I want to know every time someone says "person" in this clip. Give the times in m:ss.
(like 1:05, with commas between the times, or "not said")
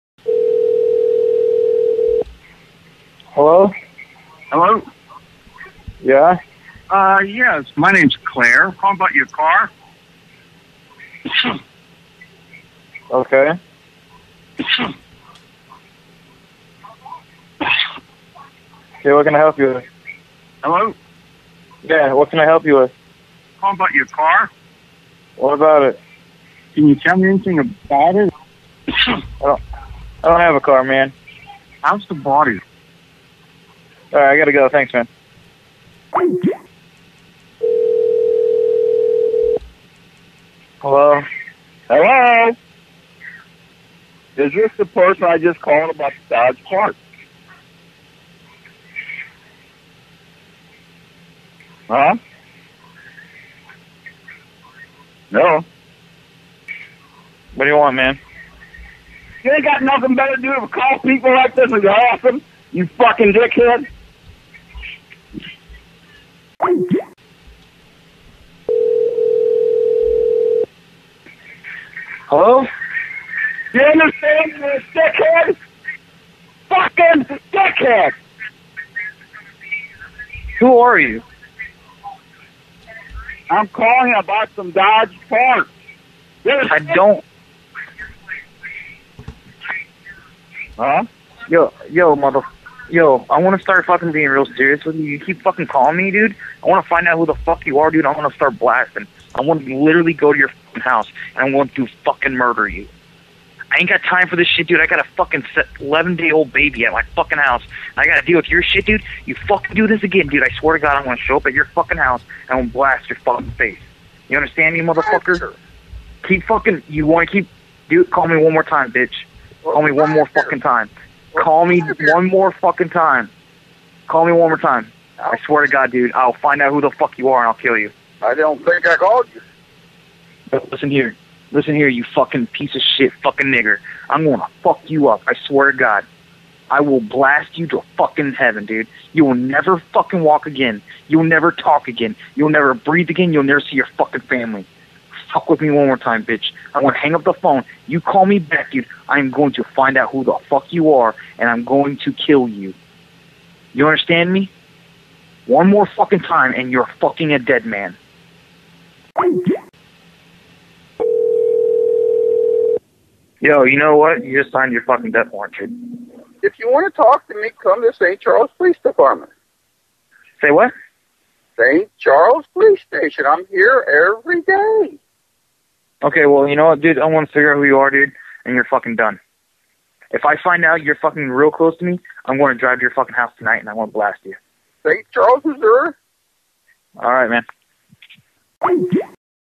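0:44.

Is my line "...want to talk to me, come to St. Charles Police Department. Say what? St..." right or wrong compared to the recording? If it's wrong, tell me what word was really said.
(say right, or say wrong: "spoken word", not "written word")
right.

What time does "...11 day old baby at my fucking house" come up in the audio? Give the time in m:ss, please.
1:45.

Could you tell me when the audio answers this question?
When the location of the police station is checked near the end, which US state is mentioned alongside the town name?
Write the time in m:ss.
3:05.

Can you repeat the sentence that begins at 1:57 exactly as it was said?
Dude, call me one more time, bitch.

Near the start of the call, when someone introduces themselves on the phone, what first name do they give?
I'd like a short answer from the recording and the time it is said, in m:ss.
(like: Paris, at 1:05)
Claire, at 0:08.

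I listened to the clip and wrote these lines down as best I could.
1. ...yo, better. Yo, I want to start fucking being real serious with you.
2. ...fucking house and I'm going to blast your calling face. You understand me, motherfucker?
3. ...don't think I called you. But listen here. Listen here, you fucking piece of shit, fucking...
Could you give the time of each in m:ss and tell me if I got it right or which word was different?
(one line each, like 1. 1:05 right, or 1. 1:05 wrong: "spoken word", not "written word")
1. 1:31 wrong: "mother", not "better"
2. 1:51 wrong: "fucking", not "calling"
3. 2:08 right.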